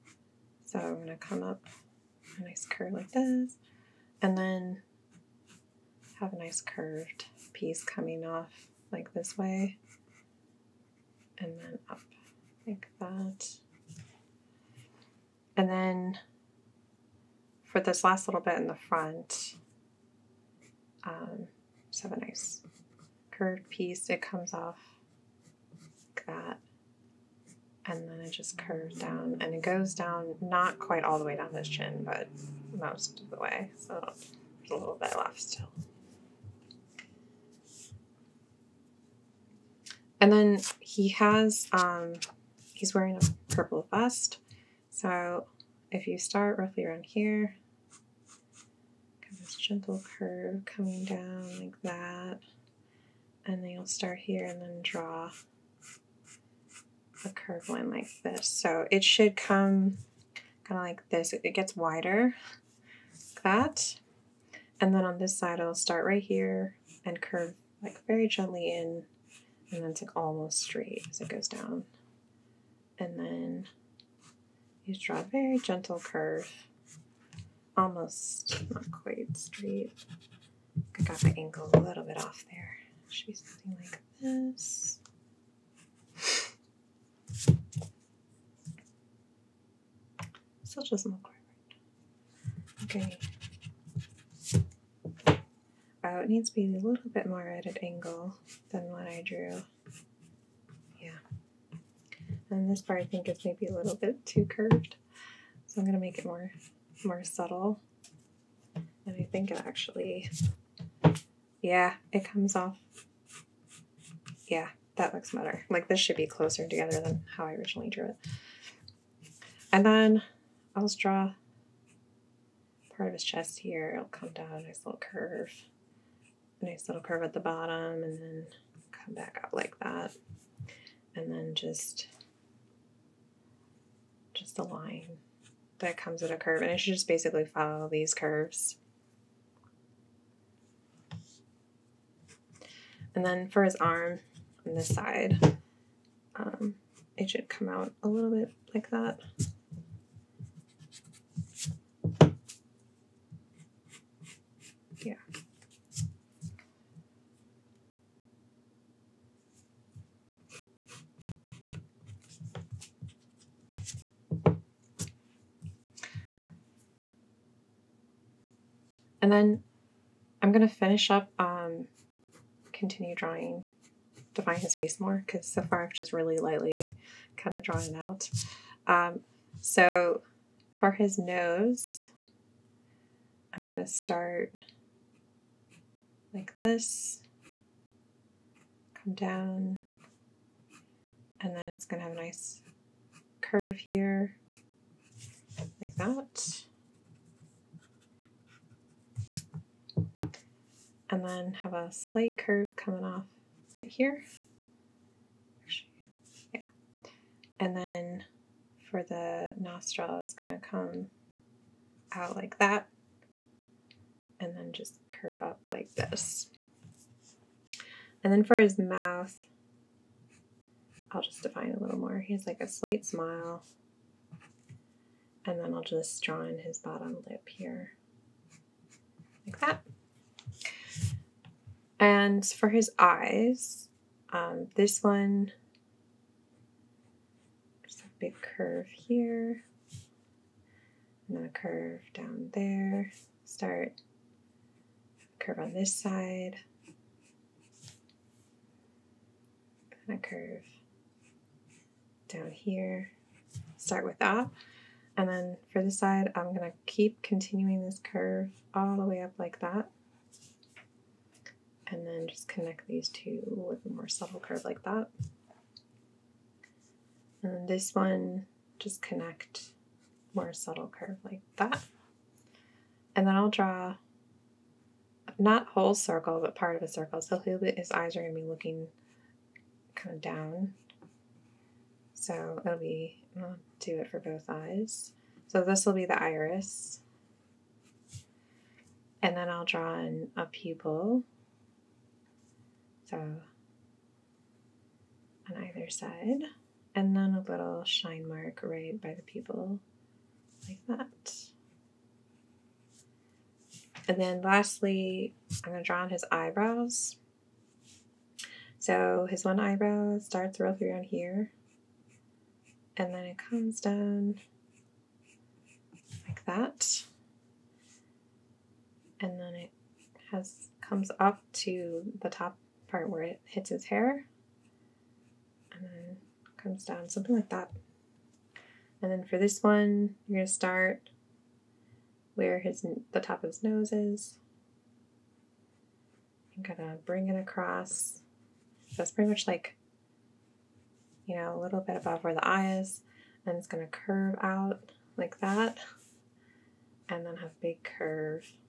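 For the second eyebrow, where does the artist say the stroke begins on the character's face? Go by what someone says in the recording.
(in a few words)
top of his nose.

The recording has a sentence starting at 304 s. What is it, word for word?
And then lastly, I'm going to draw on his eyebrows.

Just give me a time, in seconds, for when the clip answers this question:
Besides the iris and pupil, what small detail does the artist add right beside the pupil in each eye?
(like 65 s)
297 s.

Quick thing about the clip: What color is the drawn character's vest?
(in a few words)
purple.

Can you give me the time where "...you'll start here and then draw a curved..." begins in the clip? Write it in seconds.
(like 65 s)
53 s.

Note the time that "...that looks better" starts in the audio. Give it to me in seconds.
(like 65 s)
114 s.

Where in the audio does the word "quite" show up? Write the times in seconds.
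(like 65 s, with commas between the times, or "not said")
30 s, 78 s.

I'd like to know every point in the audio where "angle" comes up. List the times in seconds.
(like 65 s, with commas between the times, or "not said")
81 s, 97 s.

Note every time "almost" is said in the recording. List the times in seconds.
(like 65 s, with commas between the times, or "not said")
70 s, 77 s.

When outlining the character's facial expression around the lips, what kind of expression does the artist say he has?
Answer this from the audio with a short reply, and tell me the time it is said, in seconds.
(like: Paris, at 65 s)
slight smile, at 222 s.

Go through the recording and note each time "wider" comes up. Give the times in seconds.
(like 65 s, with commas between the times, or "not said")
61 s.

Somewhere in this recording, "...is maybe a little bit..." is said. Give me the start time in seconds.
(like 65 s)
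103 s.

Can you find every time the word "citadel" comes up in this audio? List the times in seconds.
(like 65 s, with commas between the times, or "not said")
not said.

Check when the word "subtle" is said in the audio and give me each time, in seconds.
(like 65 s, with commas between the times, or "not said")
107 s, 264 s, 270 s.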